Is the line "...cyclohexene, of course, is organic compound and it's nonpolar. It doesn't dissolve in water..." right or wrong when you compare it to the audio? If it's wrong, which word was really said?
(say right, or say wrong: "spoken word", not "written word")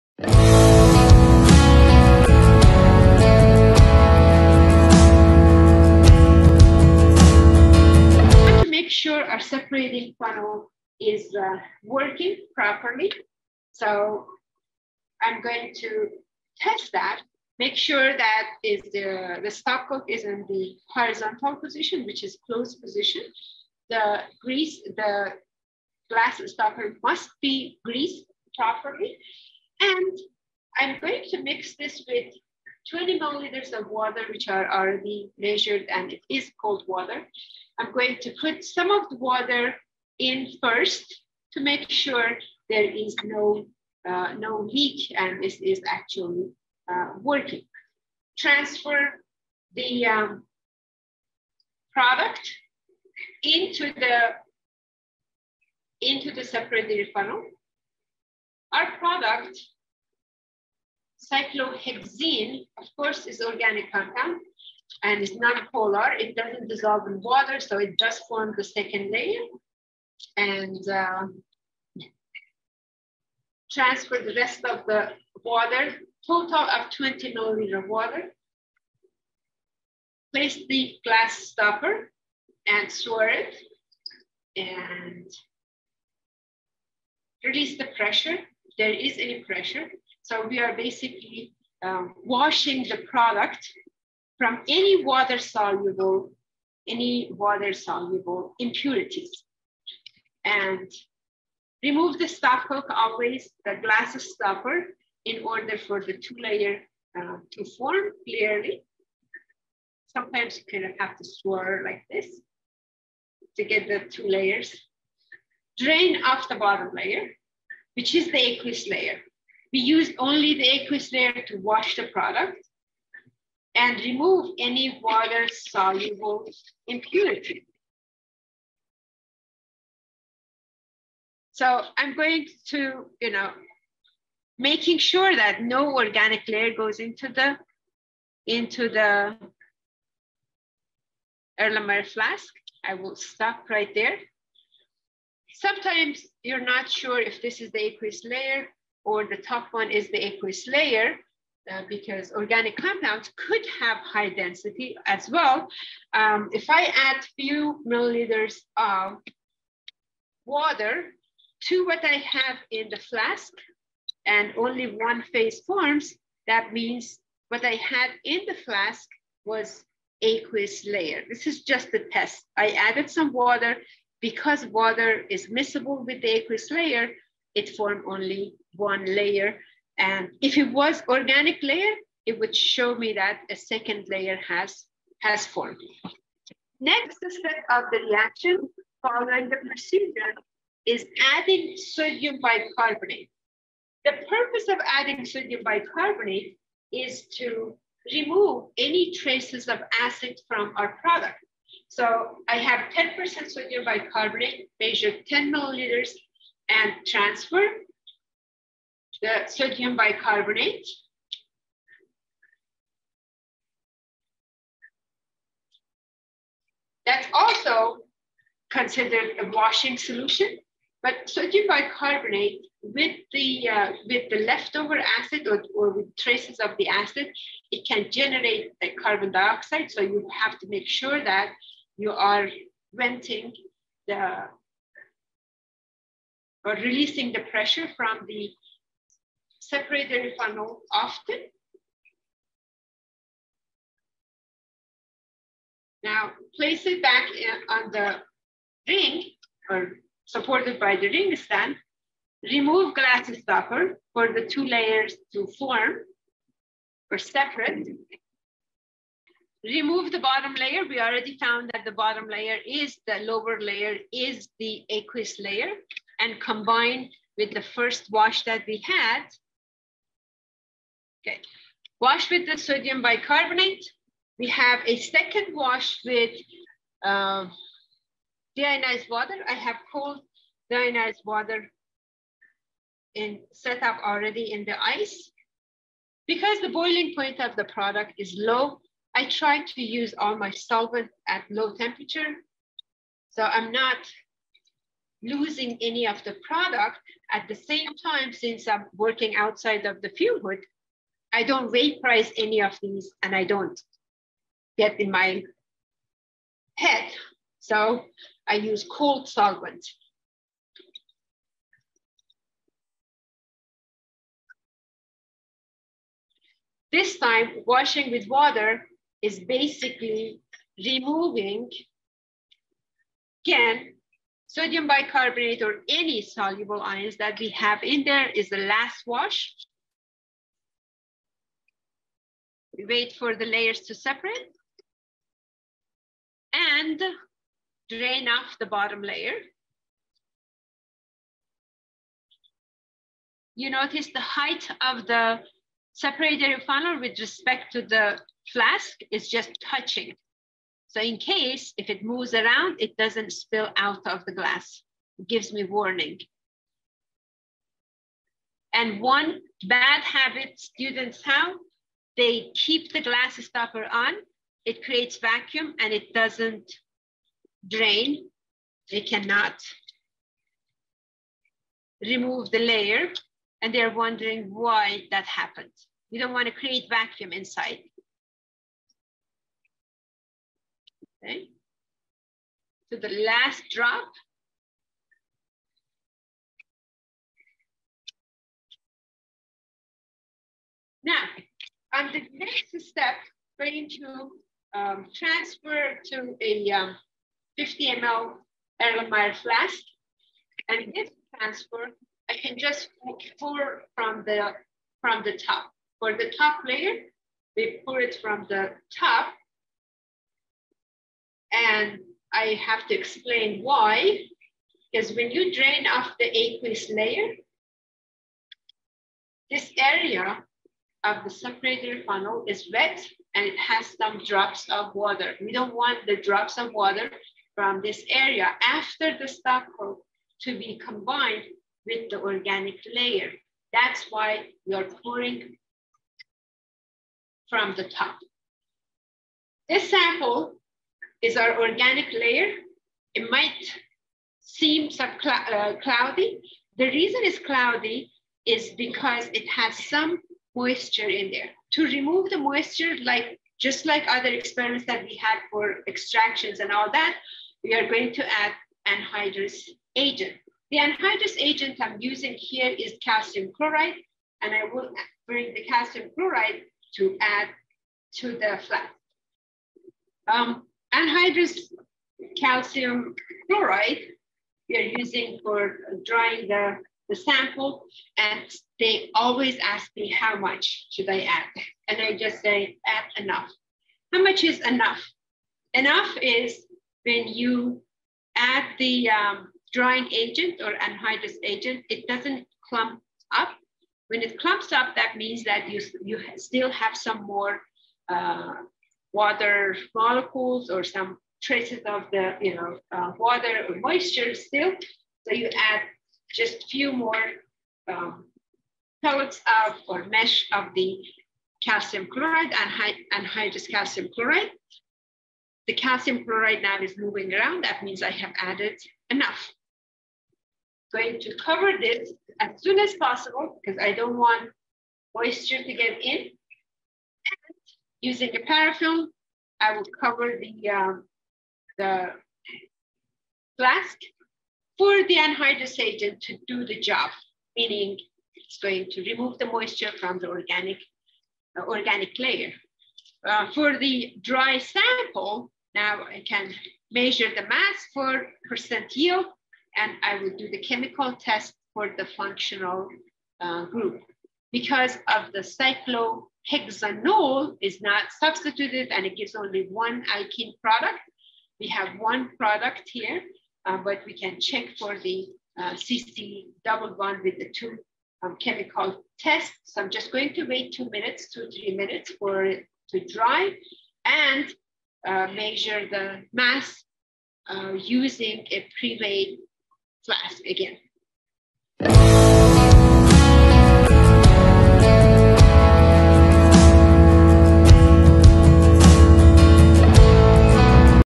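right.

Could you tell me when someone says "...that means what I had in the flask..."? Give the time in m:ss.
2:46.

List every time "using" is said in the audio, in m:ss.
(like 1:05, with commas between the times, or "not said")
7:41, 7:54, 8:48, 9:37.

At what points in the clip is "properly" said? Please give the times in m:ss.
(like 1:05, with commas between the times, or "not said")
0:12, 0:28.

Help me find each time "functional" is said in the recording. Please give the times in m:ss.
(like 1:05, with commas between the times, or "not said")
9:12.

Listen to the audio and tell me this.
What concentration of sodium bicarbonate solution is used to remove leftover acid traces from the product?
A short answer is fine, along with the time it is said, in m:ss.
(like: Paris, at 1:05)
10%, at 3:22.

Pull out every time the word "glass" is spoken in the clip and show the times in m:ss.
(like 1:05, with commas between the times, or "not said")
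0:26, 1:21, 1:43, 4:12, 5:54, 6:03.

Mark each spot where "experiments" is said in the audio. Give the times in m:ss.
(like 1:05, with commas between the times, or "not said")
7:34.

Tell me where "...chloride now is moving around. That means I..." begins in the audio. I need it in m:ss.
8:36.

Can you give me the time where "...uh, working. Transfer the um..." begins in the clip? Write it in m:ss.
0:46.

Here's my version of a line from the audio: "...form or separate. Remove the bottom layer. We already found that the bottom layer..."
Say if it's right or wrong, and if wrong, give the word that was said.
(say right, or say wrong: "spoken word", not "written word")
right.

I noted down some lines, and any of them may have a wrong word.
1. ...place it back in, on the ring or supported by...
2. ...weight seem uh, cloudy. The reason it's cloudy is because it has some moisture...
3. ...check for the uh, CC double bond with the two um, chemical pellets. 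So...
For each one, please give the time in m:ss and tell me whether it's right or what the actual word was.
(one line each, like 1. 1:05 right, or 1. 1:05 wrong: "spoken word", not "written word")
1. 4:06 right
2. 7:23 wrong: "might", not "weight"
3. 9:24 wrong: "tests", not "pellets".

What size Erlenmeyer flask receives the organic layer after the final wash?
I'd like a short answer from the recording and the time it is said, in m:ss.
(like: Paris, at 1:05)
50 ml, at 6:37.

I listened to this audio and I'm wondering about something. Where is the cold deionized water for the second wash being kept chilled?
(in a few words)
in the ice.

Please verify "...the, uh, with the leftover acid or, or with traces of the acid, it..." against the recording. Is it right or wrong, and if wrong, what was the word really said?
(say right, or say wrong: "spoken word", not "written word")
right.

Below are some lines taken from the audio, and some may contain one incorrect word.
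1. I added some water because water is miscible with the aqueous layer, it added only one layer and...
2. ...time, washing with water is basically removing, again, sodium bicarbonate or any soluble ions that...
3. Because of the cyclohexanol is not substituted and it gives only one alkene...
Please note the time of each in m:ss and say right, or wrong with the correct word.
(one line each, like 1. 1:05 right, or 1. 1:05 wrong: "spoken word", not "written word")
1. 2:52 wrong: "formed", not "added"
2. 5:17 right
3. 9:14 right.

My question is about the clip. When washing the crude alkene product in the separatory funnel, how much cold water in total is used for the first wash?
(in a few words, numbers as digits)
20 milliliters.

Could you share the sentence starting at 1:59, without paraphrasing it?
We use only the aqueous layer to wash the product and remove any water-soluble impurity.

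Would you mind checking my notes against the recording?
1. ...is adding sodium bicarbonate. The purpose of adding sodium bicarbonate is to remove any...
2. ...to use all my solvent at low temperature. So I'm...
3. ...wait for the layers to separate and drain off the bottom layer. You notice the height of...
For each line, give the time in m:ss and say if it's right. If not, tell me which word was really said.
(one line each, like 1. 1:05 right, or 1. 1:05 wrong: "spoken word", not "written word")
1. 3:10 right
2. 4:49 right
3. 5:32 right.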